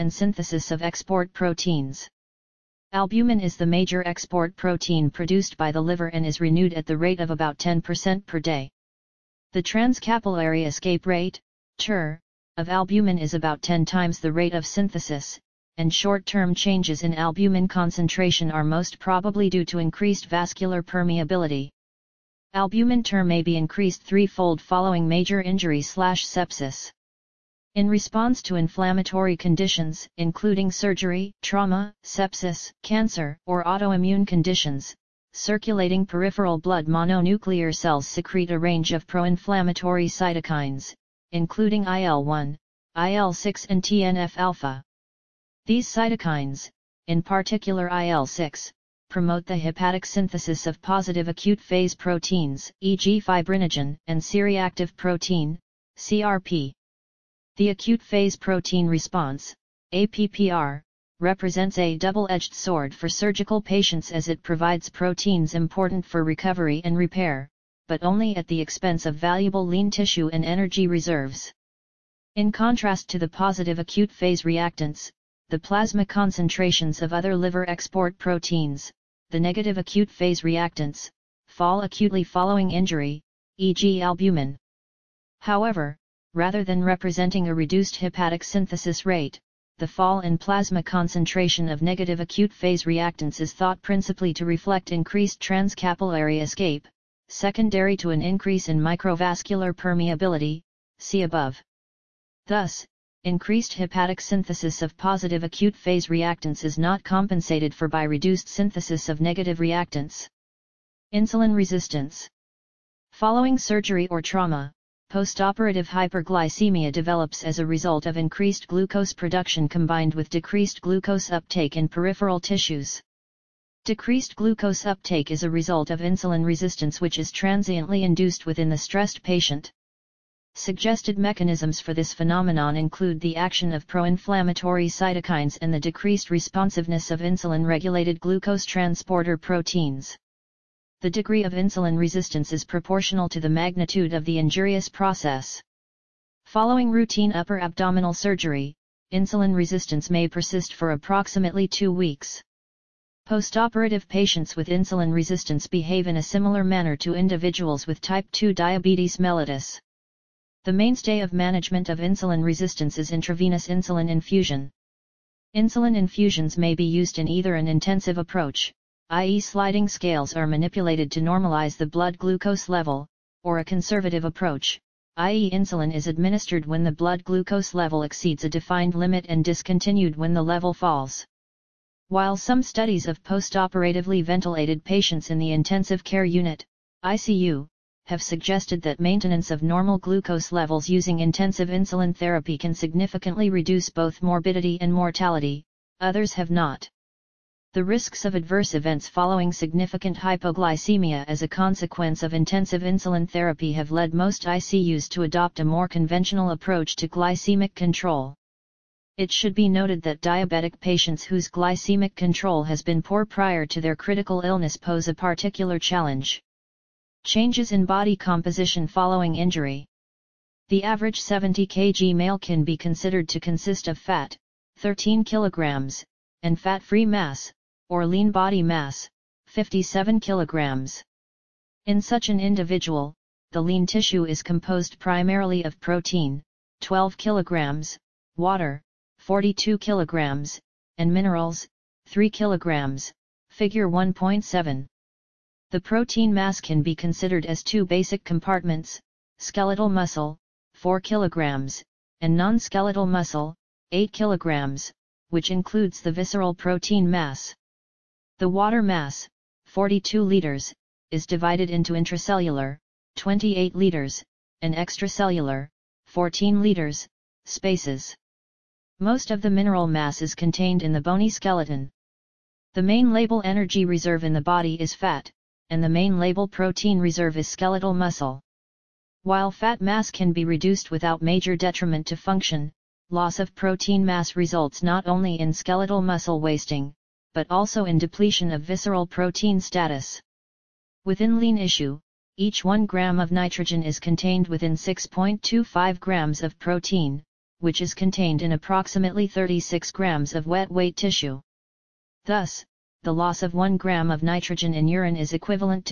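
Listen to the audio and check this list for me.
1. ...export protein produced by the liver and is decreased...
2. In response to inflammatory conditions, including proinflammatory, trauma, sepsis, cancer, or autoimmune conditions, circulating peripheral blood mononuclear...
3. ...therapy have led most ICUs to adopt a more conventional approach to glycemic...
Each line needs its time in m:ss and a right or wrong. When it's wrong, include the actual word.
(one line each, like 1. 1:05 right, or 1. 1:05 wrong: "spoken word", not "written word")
1. 0:04 wrong: "renewed", not "decreased"
2. 0:27 wrong: "surgery", not "proinflammatory"
3. 3:23 right.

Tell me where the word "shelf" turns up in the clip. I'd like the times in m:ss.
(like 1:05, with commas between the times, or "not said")
not said.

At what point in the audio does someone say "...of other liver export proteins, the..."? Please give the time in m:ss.
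1:17.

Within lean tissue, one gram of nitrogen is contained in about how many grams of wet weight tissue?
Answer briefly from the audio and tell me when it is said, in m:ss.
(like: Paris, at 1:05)
36 grams, at 4:59.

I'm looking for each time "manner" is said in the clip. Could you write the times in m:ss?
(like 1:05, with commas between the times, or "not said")
2:36.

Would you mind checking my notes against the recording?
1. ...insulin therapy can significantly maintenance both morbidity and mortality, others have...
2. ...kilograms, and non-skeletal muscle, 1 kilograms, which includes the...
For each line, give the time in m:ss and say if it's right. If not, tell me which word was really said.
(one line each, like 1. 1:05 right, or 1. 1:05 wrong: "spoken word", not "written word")
1. 3:11 wrong: "reduce", not "maintenance"
2. 4:11 wrong: "8", not "1".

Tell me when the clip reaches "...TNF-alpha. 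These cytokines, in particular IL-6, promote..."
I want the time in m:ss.
0:43.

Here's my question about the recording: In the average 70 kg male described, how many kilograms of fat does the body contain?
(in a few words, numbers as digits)
13 kg.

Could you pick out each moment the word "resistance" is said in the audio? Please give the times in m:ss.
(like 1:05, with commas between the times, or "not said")
1:51, 2:06, 2:21, 2:29, 2:35, 2:42.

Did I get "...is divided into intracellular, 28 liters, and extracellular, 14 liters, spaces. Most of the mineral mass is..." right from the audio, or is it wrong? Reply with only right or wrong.
right.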